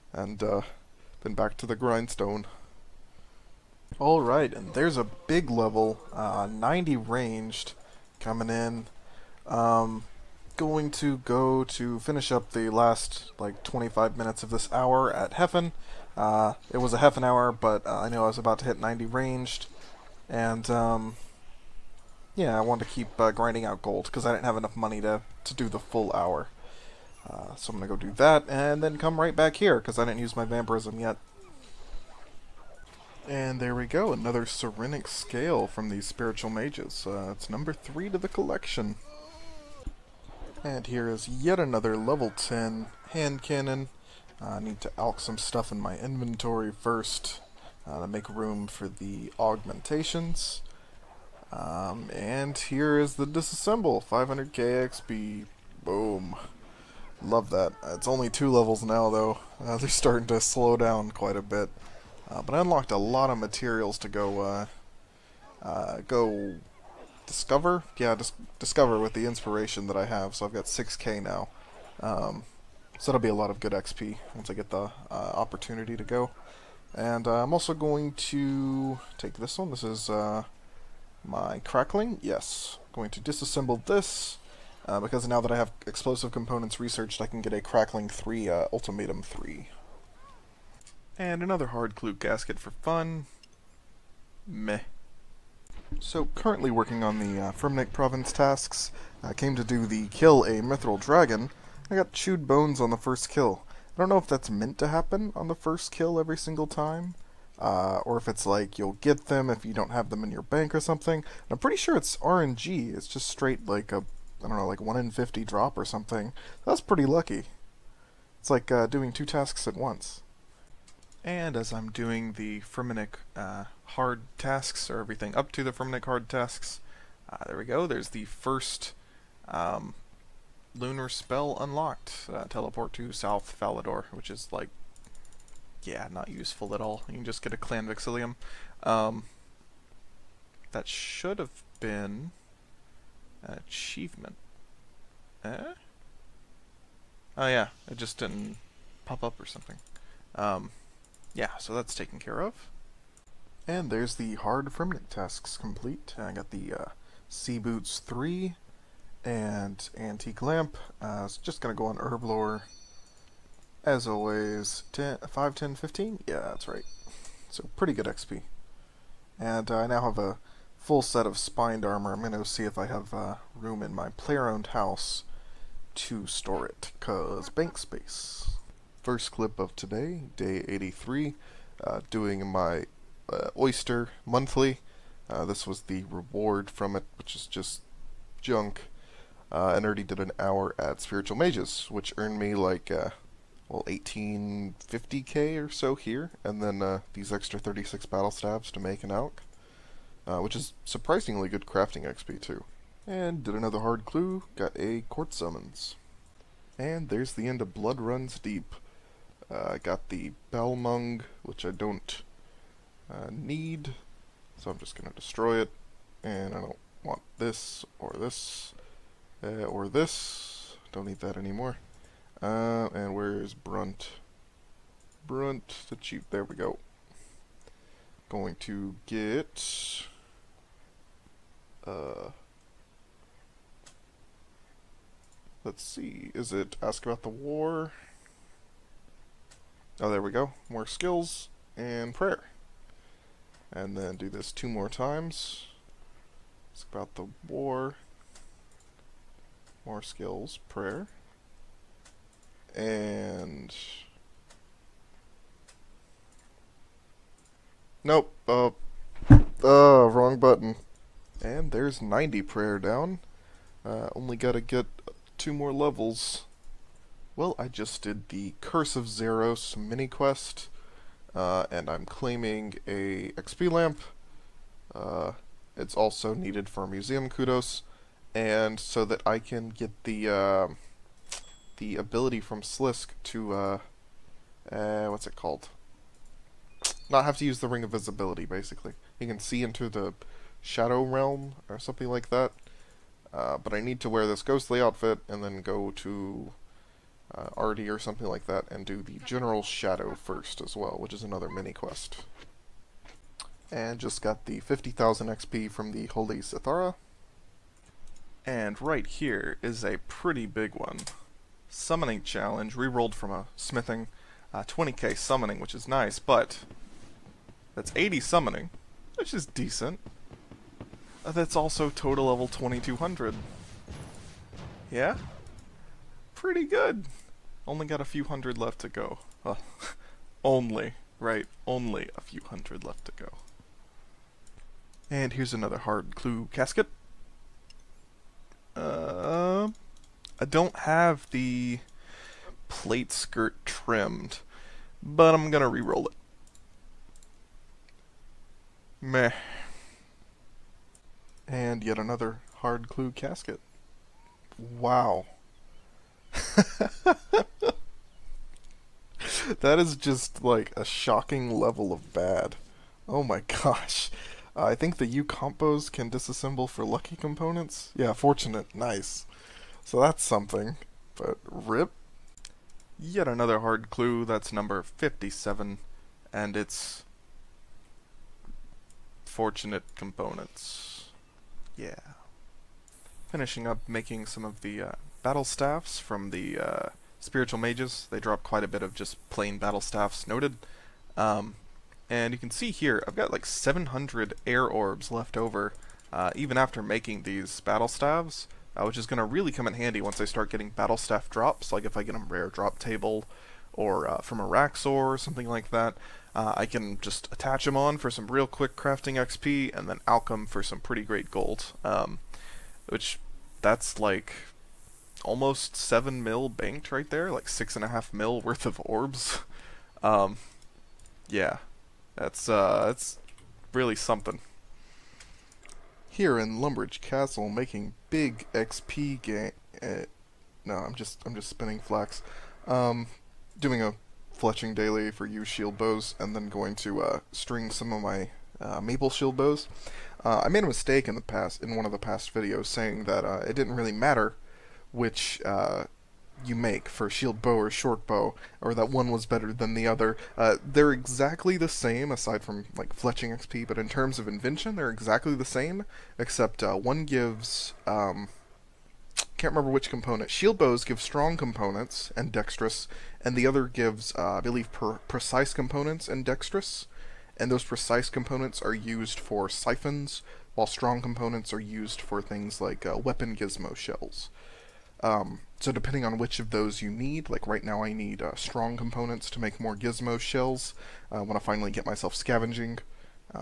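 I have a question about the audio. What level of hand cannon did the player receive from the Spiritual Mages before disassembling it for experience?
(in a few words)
Level 10.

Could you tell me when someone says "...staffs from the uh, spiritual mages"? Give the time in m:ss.
6:25.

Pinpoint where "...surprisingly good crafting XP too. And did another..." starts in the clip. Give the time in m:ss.
3:20.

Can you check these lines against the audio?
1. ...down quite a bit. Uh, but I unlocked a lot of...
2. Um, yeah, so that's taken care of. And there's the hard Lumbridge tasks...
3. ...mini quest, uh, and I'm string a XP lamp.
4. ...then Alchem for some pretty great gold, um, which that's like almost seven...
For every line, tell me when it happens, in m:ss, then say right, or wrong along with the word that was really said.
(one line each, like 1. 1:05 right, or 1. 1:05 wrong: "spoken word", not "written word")
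1. 1:00 right
2. 2:30 wrong: "Fremennik", not "Lumbridge"
3. 4:29 wrong: "claiming", not "string"
4. 6:49 right.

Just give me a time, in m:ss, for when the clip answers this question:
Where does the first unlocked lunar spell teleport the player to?
2:13.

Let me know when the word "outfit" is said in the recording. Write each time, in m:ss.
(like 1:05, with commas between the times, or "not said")
4:54.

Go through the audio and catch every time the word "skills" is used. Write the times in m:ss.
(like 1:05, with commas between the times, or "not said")
4:00, 4:10.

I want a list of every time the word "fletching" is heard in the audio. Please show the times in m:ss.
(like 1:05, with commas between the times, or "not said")
7:14, 7:32.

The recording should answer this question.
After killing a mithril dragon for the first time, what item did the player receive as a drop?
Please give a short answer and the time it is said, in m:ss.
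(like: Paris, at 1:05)
Chewed bones, at 1:42.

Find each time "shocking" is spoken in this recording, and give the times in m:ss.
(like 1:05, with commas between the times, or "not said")
6:00.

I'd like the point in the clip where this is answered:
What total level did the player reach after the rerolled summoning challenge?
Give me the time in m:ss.
5:22.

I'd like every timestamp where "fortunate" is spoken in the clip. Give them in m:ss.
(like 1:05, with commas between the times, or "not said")
6:08, 6:19.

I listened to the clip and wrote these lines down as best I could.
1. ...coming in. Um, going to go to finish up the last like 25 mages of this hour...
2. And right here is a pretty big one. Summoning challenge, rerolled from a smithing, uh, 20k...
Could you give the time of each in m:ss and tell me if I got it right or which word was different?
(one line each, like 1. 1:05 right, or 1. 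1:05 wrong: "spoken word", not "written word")
1. 0:08 wrong: "minutes", not "mages"
2. 5:08 right.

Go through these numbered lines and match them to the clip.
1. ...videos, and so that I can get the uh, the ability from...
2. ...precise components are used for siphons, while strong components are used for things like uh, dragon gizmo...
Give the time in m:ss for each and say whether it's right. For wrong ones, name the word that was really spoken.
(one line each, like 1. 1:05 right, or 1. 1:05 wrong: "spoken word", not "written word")
1. 4:37 wrong: "kudos", not "videos"
2. 7:47 wrong: "weapon", not "dragon".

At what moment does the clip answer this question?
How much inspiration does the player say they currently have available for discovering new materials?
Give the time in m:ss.
1:10.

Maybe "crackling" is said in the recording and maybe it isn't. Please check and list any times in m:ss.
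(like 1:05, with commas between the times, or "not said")
1:21, 1:27.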